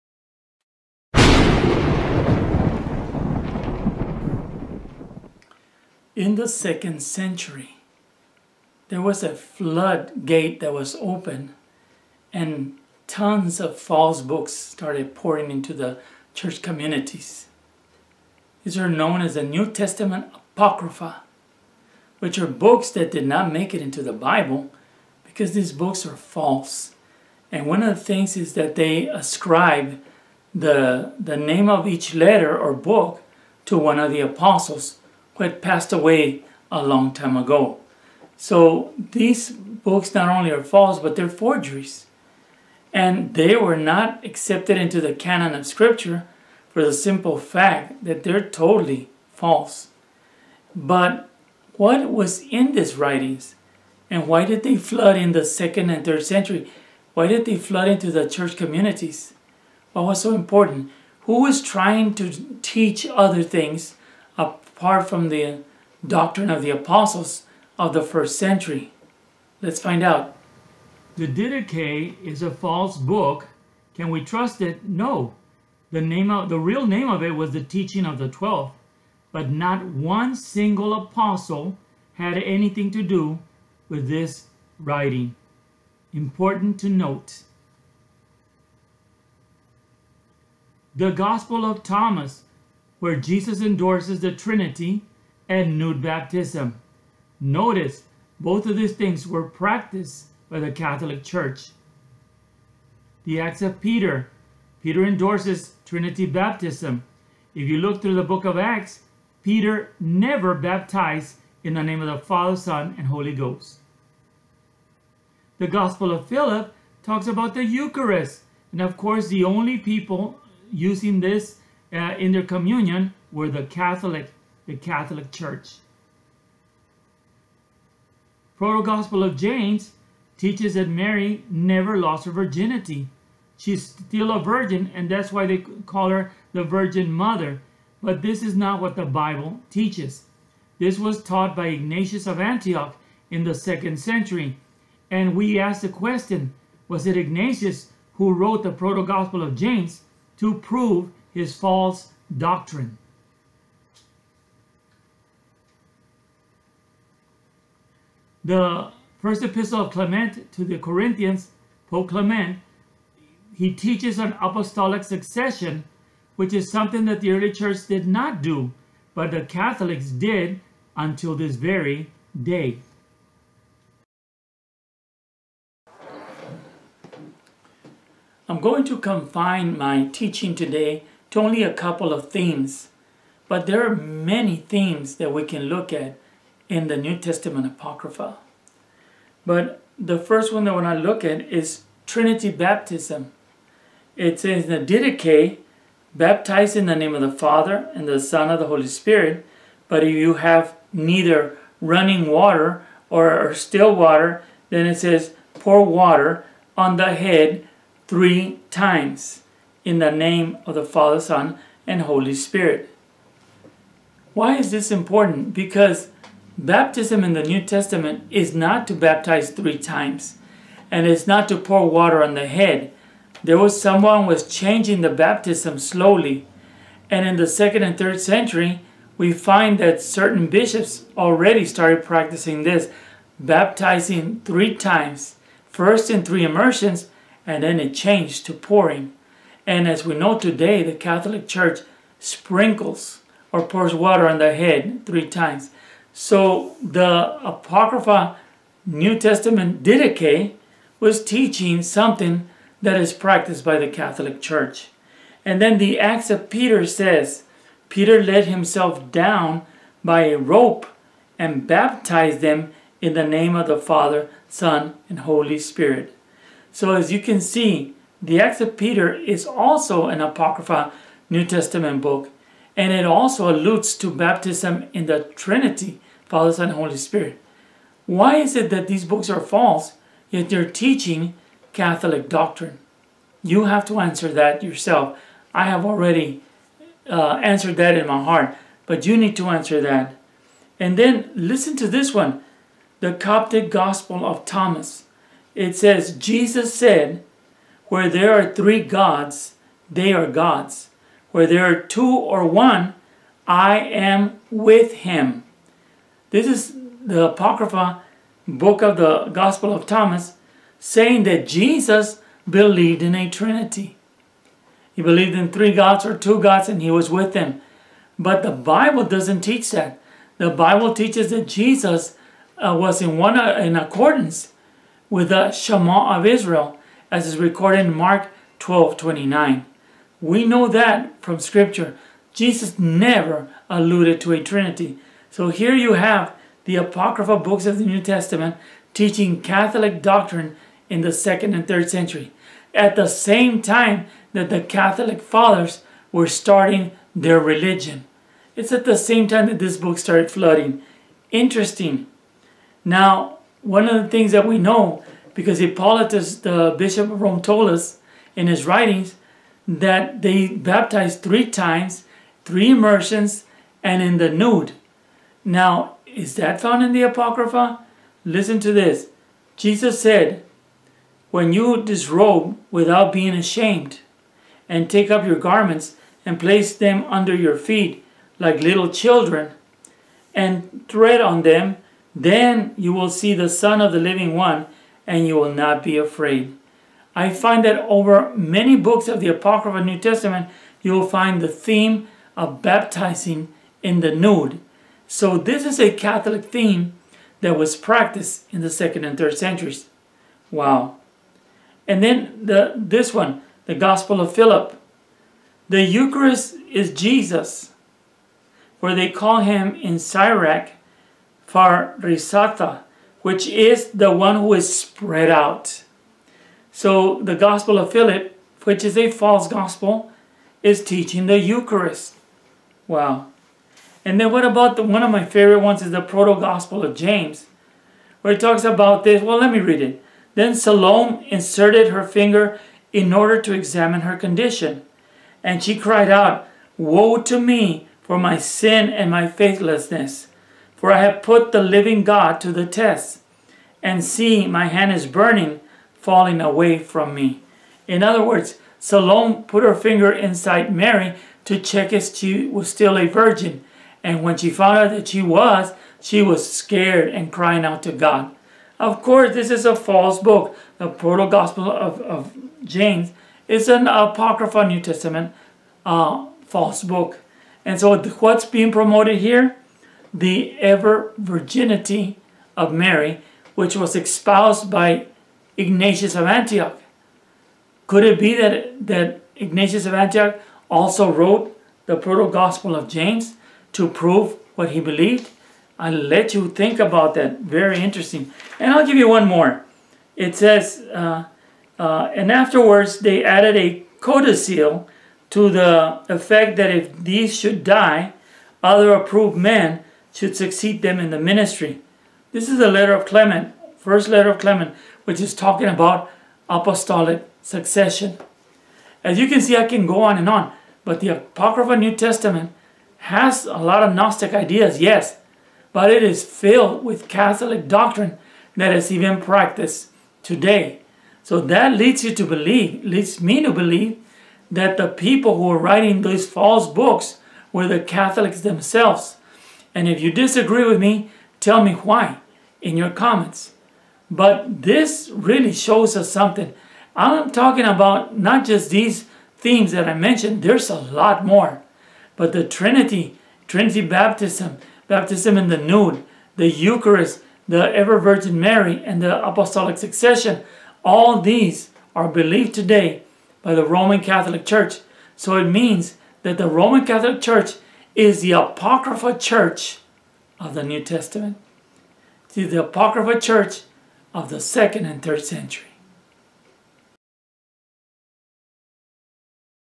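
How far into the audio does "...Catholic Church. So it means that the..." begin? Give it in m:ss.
9:14.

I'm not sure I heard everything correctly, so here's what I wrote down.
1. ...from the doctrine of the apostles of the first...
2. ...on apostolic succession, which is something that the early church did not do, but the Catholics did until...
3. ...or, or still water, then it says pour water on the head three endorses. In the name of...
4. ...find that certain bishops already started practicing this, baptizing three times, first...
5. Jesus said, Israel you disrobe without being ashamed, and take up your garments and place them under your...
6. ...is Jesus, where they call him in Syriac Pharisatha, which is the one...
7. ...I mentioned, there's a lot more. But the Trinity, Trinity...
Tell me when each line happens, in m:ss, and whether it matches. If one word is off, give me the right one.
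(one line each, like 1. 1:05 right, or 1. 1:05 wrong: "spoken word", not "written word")
1. 1:05 right
2. 2:44 right
3. 3:23 wrong: "times", not "endorses"
4. 3:49 right
5. 6:09 wrong: "When", not "Israel"
6. 6:46 right
7. 8:59 right.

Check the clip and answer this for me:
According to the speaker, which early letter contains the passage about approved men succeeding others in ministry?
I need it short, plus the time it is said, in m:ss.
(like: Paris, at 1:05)
First letter of Clement, at 8:23.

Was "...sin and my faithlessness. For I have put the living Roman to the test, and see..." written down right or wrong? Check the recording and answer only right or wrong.
wrong.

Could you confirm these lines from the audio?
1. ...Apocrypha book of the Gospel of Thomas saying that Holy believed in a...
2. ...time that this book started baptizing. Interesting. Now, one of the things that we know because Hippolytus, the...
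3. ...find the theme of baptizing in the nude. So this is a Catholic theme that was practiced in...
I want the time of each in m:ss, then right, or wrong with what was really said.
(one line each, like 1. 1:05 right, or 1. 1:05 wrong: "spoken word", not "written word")
1. 5:07 wrong: "Jesus", not "Holy"
2. 5:49 wrong: "flooding", not "baptizing"
3. 6:31 right.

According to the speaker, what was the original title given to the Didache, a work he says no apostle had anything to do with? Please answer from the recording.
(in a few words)
The Teaching of the Twelve.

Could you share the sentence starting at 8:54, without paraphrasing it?
But this really shows us something.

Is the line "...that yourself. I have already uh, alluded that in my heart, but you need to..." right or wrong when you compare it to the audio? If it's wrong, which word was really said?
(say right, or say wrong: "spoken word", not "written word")
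wrong: "answered", not "alluded".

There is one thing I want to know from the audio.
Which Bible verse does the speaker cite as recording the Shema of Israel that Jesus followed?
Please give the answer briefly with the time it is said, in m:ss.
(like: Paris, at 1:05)
Mark 12:29, at 5:27.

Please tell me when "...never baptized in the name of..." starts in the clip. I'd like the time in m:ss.
1:49.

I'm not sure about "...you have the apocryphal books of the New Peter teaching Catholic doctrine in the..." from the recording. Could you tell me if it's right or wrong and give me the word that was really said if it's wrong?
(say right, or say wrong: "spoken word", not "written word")
wrong: "Testament", not "Peter".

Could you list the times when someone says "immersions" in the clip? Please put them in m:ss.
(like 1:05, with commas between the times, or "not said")
3:56, 6:02.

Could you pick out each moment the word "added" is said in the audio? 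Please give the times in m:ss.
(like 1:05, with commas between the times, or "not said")
8:13.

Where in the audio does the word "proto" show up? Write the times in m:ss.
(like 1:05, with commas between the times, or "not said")
2:08, 2:28, 7:06, 7:40, 8:01.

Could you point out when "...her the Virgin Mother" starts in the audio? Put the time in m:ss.
2:16.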